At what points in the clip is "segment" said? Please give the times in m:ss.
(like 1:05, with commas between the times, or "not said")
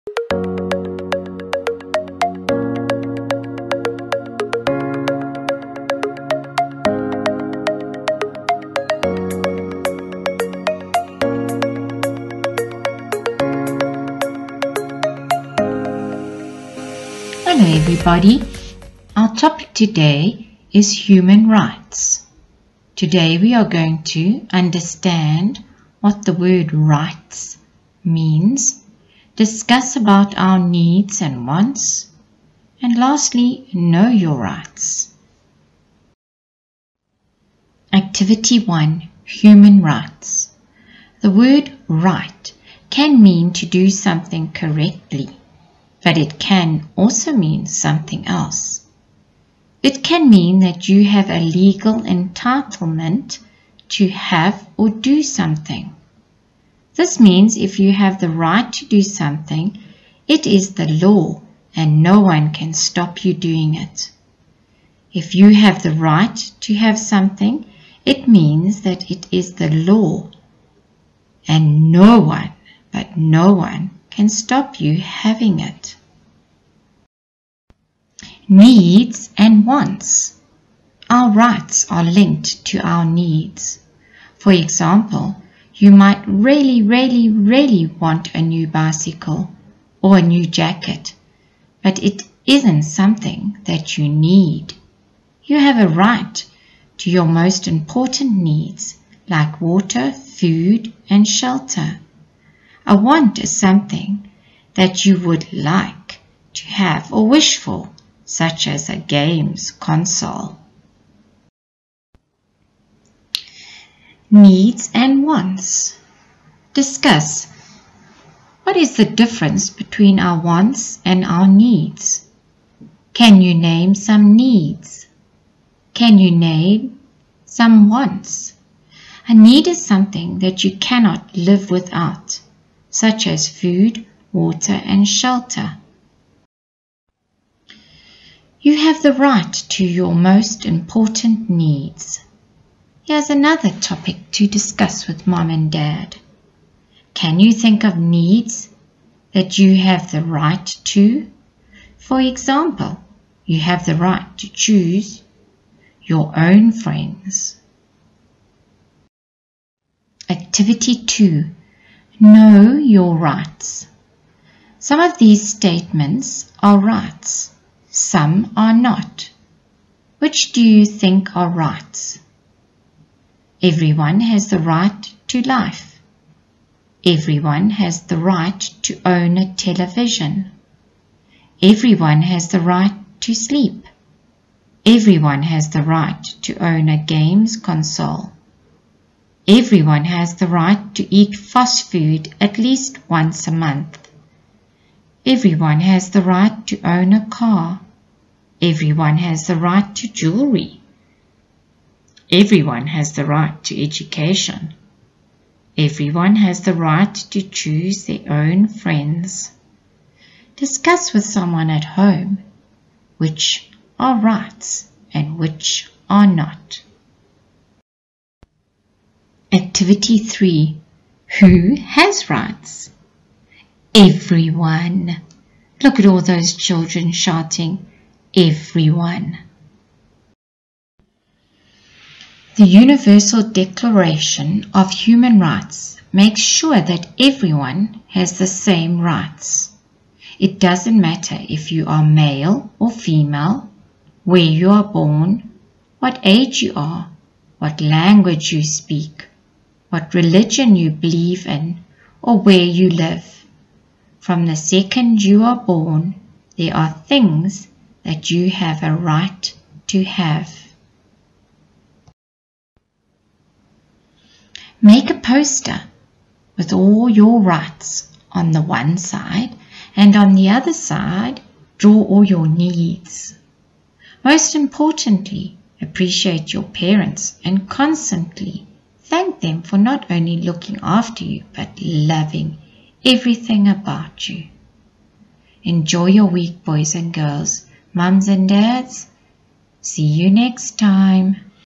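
not said.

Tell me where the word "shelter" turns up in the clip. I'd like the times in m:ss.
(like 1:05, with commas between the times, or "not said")
1:41, 2:15.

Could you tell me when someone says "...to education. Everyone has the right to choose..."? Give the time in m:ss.
3:23.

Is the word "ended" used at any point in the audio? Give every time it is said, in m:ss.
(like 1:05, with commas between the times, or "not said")
not said.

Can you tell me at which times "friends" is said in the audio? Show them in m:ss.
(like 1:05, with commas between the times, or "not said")
2:36, 3:28.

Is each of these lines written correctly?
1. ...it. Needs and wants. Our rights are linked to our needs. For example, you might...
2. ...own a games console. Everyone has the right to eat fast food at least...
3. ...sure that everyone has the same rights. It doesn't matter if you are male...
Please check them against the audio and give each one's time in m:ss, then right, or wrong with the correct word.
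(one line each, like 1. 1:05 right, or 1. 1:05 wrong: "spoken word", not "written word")
1. 1:15 right
2. 3:06 right
3. 3:56 right.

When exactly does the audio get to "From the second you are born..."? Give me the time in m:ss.
4:14.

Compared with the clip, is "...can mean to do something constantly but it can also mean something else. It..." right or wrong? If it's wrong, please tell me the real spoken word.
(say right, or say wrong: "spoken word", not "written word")
wrong: "correctly", not "constantly".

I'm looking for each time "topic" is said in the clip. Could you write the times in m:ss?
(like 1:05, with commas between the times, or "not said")
0:19, 2:23.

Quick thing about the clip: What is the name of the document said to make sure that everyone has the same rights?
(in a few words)
Universal Declaration of Human Rights.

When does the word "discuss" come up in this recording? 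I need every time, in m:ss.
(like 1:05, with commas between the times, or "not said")
0:29, 1:56, 2:24, 3:30.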